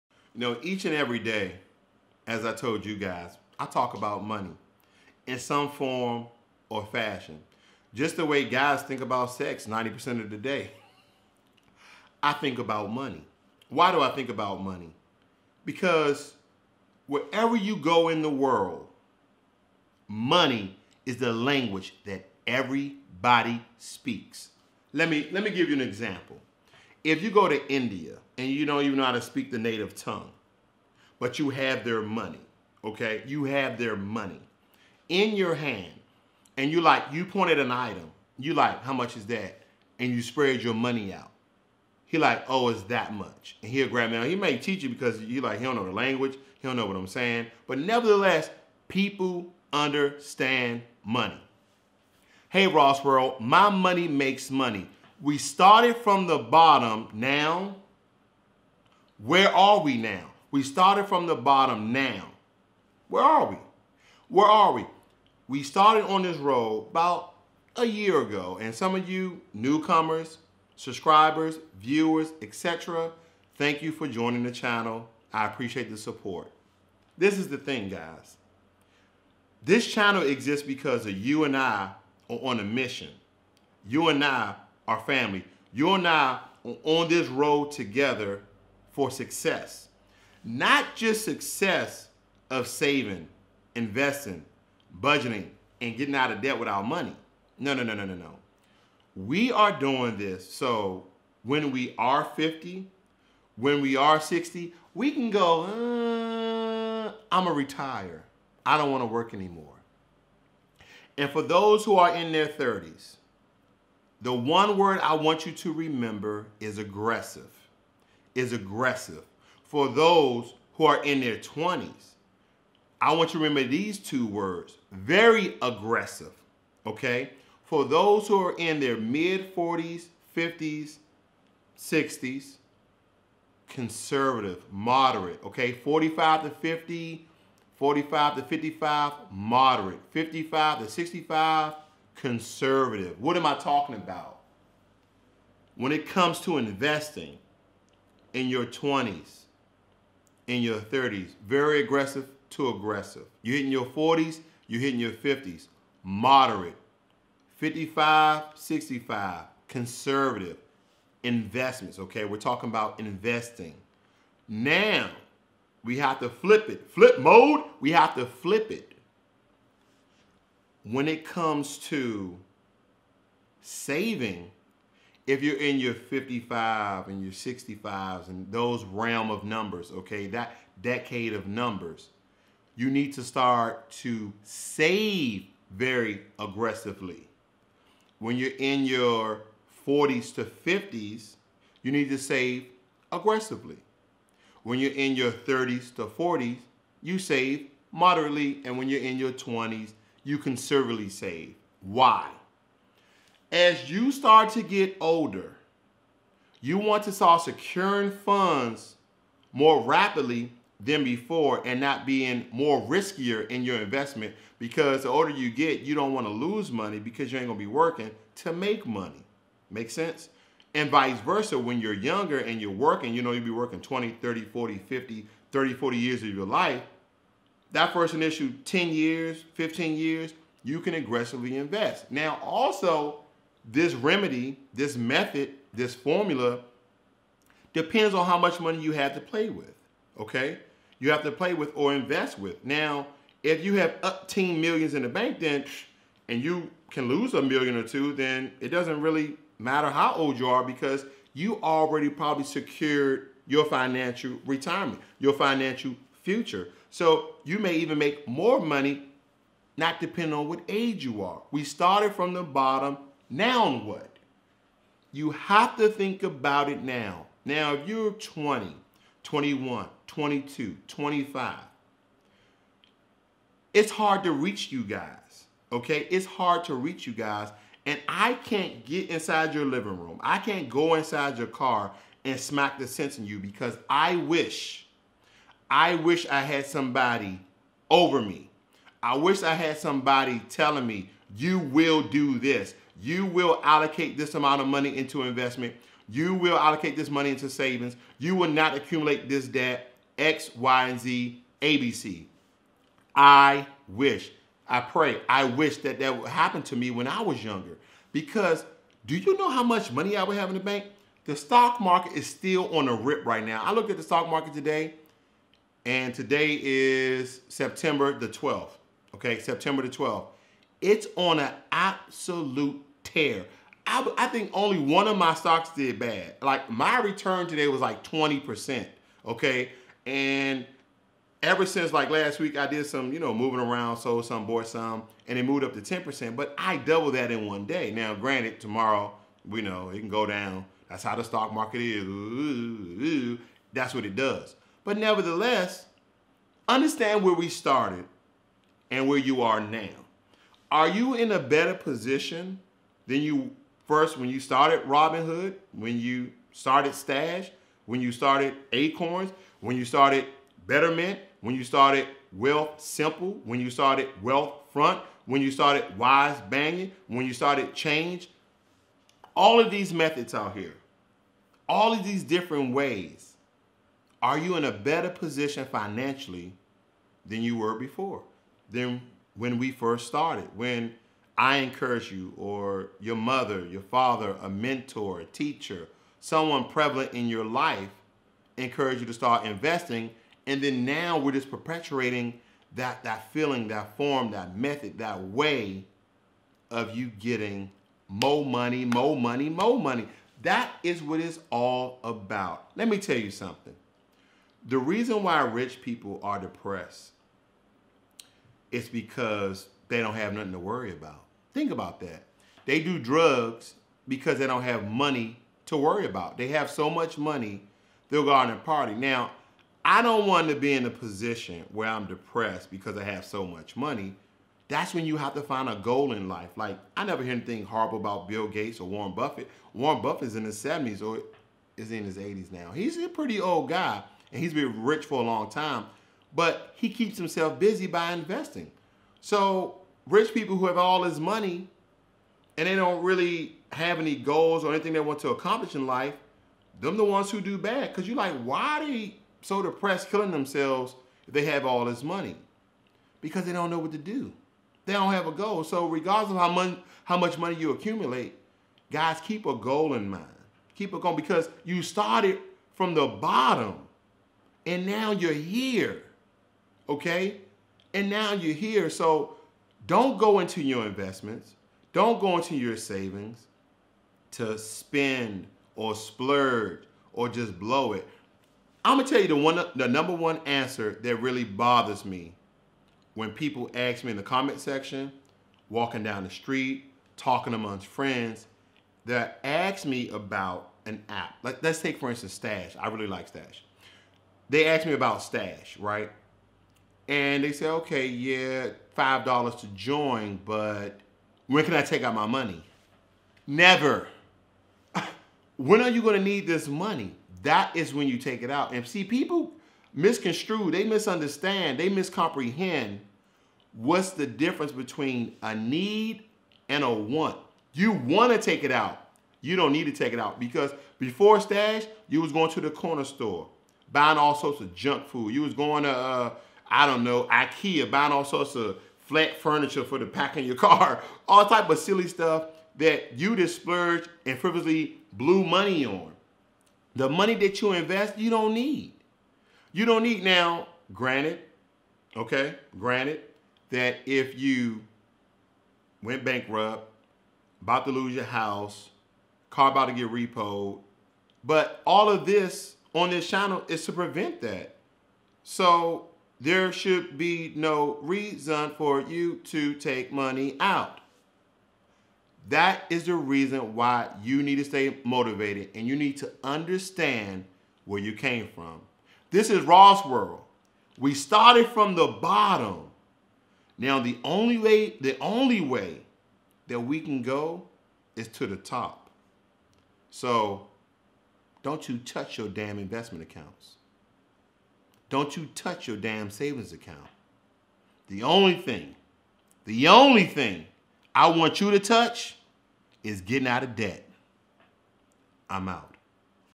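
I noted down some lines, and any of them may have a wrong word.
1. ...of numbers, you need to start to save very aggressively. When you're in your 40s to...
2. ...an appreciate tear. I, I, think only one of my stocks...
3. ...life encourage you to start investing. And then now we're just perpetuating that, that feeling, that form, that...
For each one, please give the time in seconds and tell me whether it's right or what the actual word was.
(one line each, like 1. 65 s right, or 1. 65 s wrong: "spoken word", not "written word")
1. 181 s right
2. 321 s wrong: "absolute", not "appreciate"
3. 387 s right.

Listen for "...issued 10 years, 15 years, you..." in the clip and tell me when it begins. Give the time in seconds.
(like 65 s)
228 s.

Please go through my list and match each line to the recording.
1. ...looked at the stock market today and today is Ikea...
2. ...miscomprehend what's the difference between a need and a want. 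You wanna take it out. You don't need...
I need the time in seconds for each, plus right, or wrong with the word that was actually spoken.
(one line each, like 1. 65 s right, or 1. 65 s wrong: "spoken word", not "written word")
1. 313 s wrong: "September", not "Ikea"
2. 511 s right.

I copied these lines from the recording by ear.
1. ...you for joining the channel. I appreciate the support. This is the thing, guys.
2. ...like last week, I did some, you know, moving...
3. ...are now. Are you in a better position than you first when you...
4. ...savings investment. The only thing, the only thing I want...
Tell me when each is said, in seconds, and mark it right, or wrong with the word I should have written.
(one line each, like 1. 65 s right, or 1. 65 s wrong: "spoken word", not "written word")
1. 73 s right
2. 331 s right
3. 349 s right
4. 586 s wrong: "account", not "investment".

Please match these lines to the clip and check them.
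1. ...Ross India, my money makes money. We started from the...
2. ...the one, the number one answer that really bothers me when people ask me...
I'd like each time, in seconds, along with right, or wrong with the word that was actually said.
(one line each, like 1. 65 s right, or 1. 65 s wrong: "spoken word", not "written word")
1. 52 s wrong: "World", not "India"
2. 479 s right.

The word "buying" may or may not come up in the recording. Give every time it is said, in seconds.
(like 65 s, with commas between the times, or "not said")
523 s, 527 s.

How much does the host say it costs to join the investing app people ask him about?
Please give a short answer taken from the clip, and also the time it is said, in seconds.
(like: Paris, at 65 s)
$5, at 498 s.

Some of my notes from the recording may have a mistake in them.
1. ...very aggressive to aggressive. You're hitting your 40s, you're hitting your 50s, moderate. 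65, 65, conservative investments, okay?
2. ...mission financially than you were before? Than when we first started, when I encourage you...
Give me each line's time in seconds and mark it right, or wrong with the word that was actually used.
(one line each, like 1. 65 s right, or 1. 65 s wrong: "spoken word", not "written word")
1. 151 s wrong: "55", not "65"
2. 375 s wrong: "position", not "mission".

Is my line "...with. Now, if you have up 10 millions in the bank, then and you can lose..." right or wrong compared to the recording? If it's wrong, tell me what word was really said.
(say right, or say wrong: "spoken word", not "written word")
right.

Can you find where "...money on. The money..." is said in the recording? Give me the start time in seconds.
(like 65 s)
535 s.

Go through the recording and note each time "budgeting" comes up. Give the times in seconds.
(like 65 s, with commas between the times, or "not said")
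94 s.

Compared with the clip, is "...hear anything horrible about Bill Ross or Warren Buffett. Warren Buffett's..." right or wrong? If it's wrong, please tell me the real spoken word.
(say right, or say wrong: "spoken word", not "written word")
wrong: "Gates", not "Ross".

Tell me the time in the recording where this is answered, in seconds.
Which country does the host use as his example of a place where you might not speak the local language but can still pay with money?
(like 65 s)
27 s.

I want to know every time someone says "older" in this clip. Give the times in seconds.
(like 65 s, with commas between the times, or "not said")
205 s, 215 s.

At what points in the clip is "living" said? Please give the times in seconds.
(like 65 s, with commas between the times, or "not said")
279 s.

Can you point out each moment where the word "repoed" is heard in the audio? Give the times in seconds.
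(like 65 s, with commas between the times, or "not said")
550 s.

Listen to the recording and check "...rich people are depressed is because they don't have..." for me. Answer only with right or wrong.
right.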